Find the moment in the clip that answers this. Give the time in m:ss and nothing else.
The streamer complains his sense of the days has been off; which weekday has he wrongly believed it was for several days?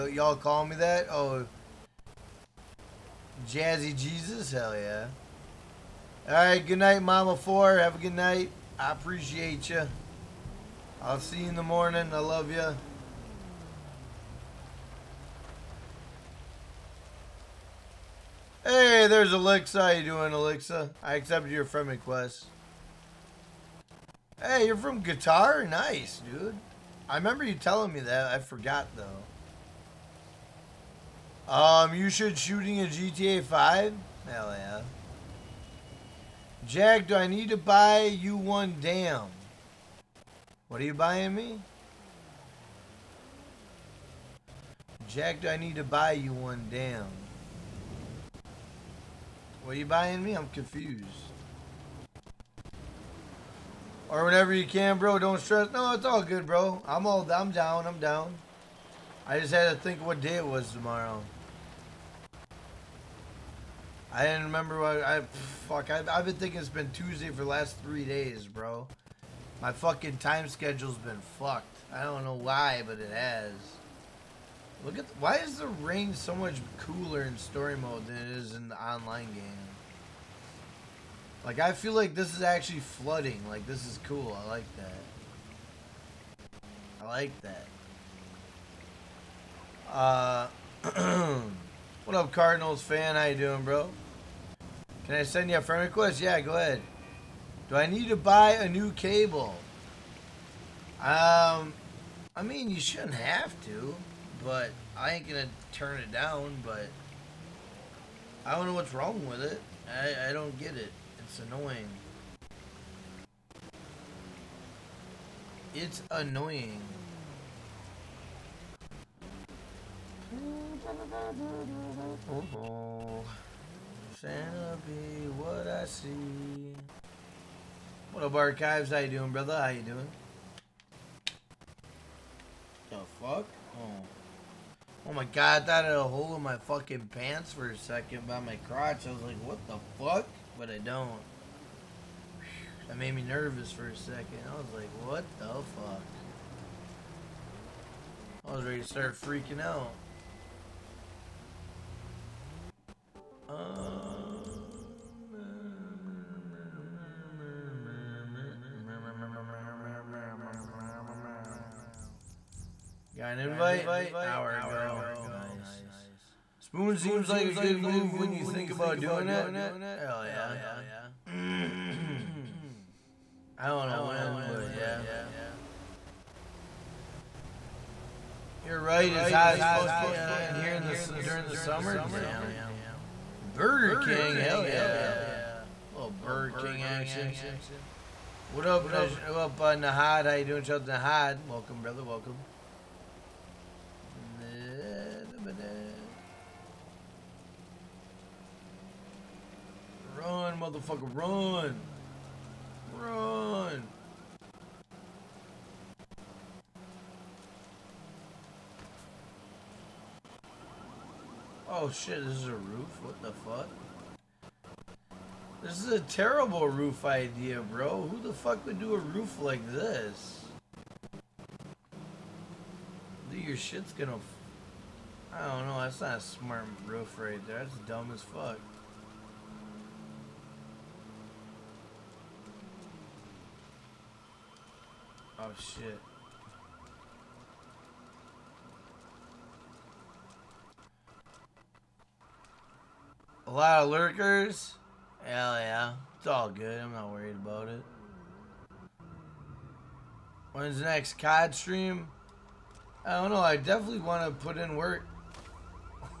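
1:06.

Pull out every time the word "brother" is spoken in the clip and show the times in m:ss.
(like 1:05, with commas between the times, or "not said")
2:09, 3:11.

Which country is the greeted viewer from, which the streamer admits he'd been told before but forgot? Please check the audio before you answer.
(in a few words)
Qatar.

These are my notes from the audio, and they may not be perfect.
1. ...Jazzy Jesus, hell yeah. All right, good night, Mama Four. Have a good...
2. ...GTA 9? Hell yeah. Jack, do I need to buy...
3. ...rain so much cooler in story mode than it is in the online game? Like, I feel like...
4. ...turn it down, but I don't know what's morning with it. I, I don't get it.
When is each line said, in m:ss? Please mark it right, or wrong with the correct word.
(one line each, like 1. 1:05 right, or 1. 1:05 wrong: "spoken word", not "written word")
1. 0:03 right
2. 0:32 wrong: "5", not "9"
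3. 1:15 right
4. 1:45 wrong: "wrong", not "morning".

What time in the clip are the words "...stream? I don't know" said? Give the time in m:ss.
4:11.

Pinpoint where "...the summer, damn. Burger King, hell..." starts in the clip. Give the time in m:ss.
3:01.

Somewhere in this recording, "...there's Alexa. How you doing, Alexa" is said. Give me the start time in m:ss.
0:19.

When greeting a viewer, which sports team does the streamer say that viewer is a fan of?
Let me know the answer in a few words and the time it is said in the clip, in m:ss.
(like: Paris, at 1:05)
Cardinals, at 1:32.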